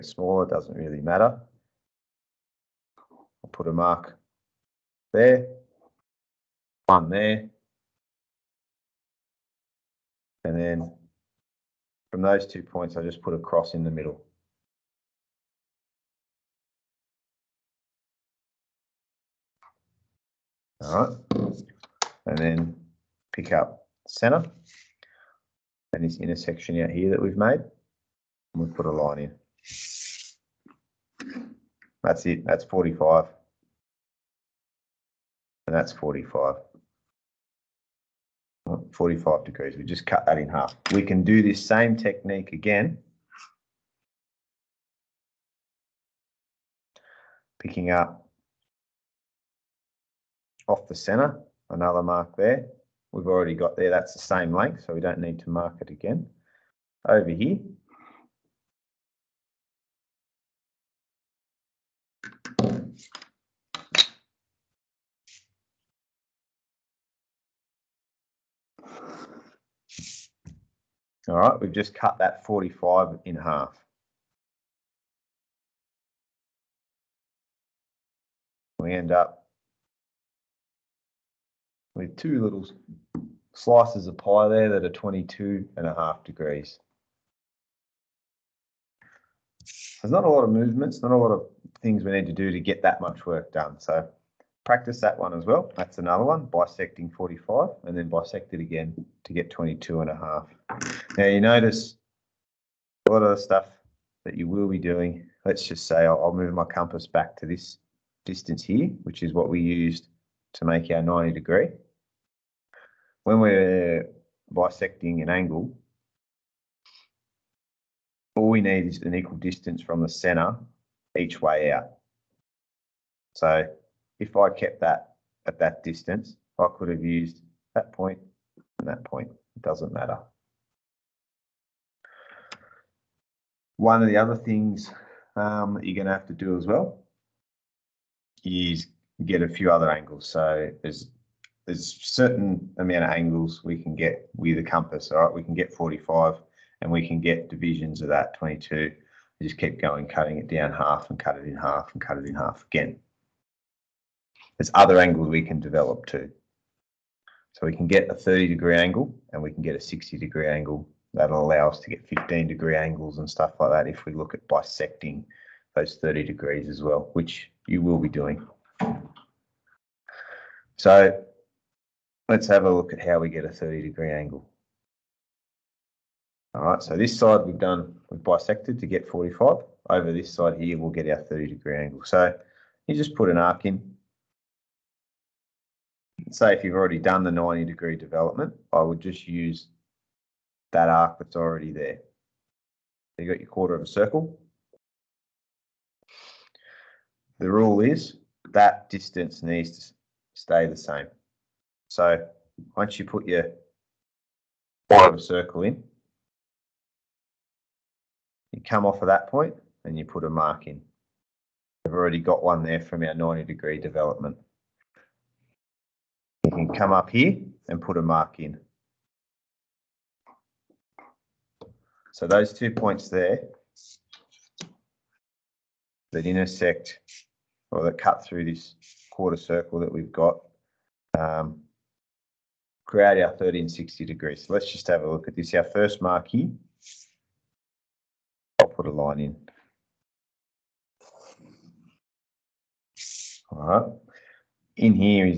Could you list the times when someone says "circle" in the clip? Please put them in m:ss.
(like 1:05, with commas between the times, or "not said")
3:13, 3:25, 3:49.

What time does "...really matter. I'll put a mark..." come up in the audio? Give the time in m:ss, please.
0:00.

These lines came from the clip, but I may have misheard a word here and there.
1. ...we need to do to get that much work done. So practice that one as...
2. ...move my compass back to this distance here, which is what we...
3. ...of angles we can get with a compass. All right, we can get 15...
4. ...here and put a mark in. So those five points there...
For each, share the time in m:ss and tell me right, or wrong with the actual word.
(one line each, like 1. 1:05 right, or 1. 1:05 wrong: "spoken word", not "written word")
1. 1:32 right
2. 1:46 right
3. 2:23 wrong: "45", not "15"
4. 3:37 wrong: "two", not "five".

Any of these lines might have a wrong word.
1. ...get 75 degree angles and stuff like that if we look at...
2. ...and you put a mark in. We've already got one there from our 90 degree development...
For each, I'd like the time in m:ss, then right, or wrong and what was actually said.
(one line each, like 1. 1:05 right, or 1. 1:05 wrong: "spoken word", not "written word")
1. 2:41 wrong: "15", not "75"
2. 3:29 right.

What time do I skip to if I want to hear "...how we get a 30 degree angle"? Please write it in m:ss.
2:53.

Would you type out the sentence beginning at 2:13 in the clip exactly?
One of the other things um, you're going to have to do as well is get a few other angles.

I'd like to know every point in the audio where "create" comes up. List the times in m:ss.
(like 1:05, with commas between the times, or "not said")
3:52.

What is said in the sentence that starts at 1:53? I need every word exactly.
When we're bisecting an angle, all we need is an equal distance from the center each way out.